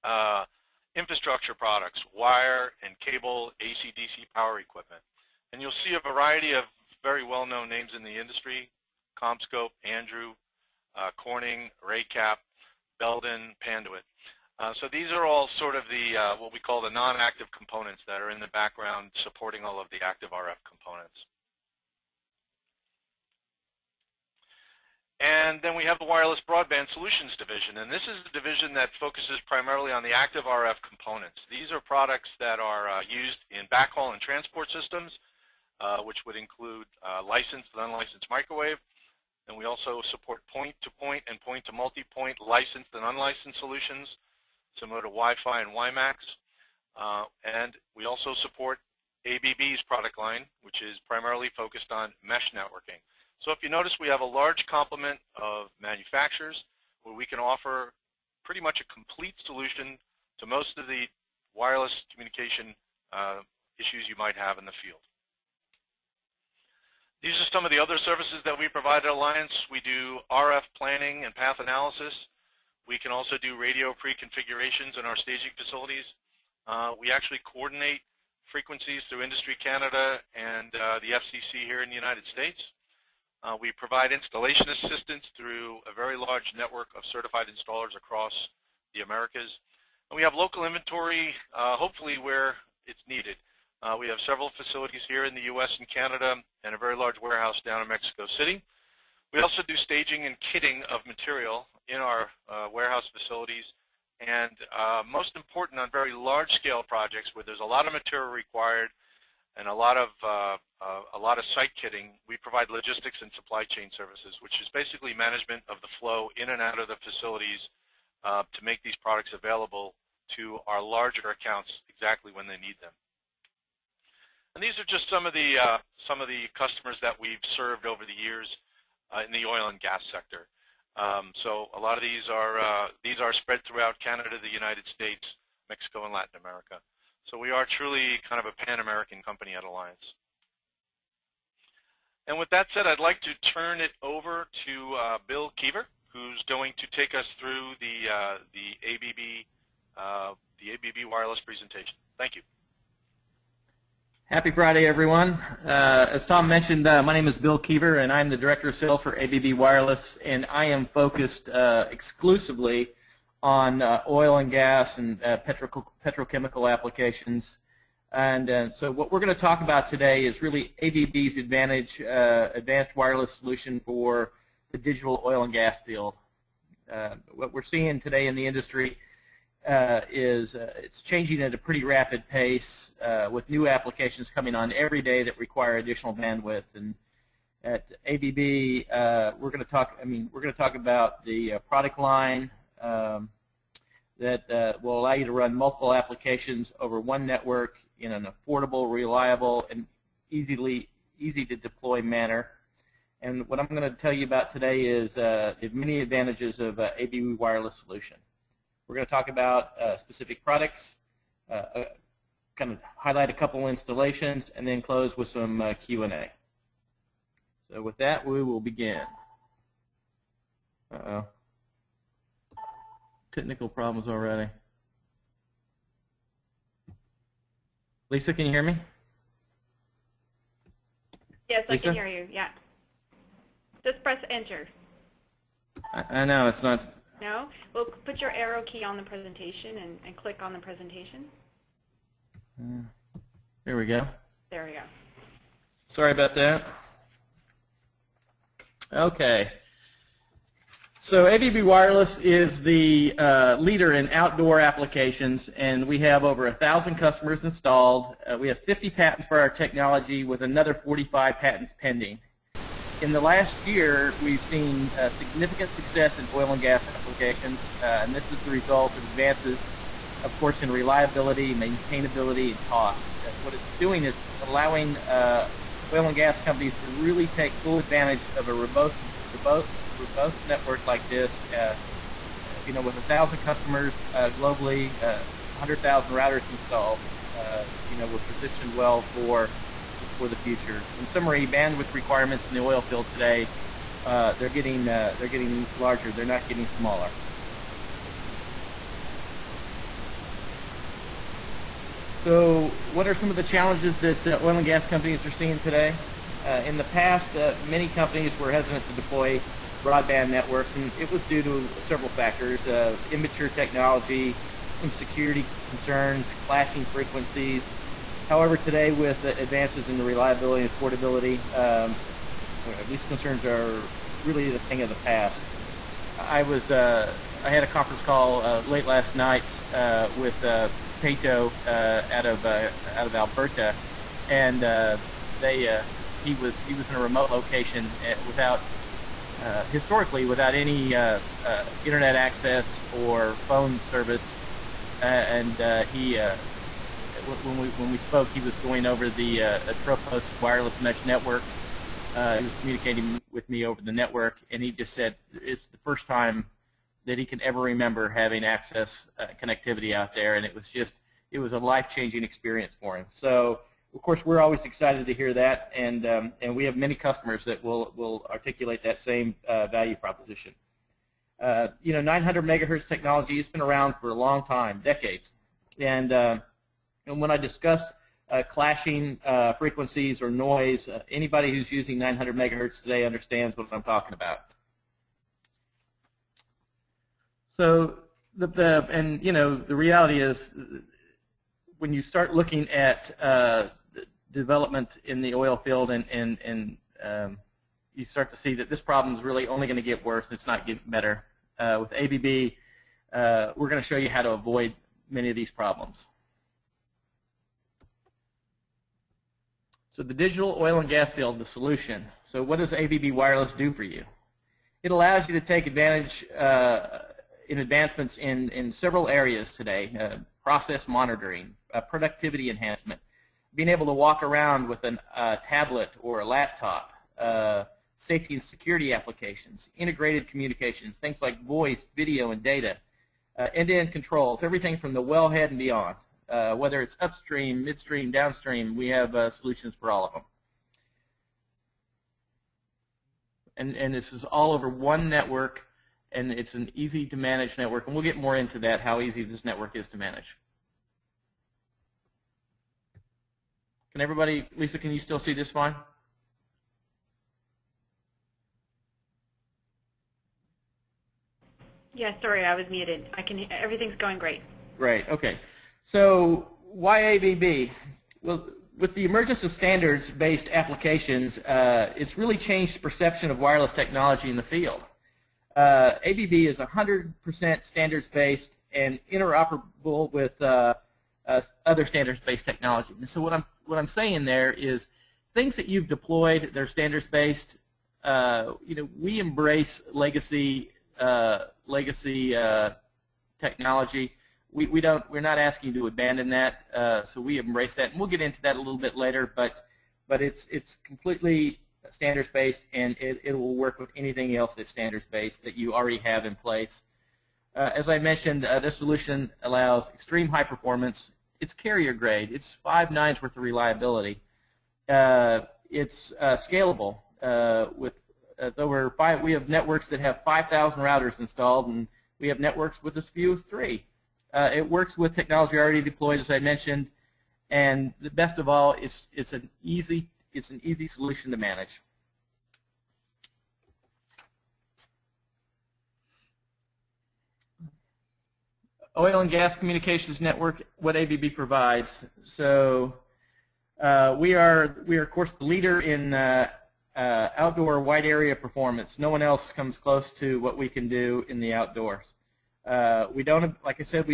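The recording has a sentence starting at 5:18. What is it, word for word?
However, today with advances in reliability and affordability, um, these concerns are really the thing of the past.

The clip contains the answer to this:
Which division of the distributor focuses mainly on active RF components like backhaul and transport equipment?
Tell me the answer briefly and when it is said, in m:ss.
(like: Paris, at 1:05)
Wireless Broadband Solutions Division, at 0:26.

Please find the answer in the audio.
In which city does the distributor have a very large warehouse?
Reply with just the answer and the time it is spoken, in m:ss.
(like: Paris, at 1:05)
Mexico City, at 1:37.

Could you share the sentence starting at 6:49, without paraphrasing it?
So the digital oil and gas field, the solution.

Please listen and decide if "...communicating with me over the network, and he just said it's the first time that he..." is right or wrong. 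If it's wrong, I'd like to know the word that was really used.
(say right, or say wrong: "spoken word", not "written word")
right.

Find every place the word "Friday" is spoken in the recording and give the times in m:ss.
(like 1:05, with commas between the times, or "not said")
2:34.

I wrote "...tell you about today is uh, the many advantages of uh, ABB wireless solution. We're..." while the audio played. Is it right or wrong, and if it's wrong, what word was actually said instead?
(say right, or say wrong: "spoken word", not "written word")
right.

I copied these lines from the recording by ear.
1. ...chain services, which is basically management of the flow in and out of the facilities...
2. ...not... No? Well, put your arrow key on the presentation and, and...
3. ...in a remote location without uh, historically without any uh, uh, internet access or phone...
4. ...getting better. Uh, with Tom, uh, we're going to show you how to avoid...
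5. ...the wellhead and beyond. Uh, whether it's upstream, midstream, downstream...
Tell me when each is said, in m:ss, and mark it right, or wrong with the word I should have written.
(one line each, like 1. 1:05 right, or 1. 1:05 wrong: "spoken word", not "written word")
1. 1:53 right
2. 3:56 right
3. 5:36 right
4. 6:40 wrong: "ABB", not "Tom"
5. 7:14 right.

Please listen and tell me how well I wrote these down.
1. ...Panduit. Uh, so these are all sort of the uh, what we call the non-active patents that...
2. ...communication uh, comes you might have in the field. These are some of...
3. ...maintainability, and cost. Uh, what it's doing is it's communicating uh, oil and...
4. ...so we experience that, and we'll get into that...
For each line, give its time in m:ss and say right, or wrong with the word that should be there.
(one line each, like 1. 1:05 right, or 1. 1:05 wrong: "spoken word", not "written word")
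1. 0:13 wrong: "components", not "patents"
2. 1:02 wrong: "issues", not "comes"
3. 4:31 wrong: "allowing", not "communicating"
4. 8:17 wrong: "embrace", not "experience".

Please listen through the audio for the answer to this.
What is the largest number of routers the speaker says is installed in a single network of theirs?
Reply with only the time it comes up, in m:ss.
8:40.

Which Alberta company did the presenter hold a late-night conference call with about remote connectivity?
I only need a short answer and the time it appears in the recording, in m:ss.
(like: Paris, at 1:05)
Peyto, at 5:31.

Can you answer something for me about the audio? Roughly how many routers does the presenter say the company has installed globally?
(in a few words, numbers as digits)
100,000.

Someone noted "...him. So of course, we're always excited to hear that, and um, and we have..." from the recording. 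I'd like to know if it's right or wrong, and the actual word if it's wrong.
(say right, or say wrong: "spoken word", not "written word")
right.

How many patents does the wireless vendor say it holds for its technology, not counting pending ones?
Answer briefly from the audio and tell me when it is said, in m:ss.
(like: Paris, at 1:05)
50, at 4:18.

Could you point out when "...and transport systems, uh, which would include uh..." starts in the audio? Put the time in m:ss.
0:34.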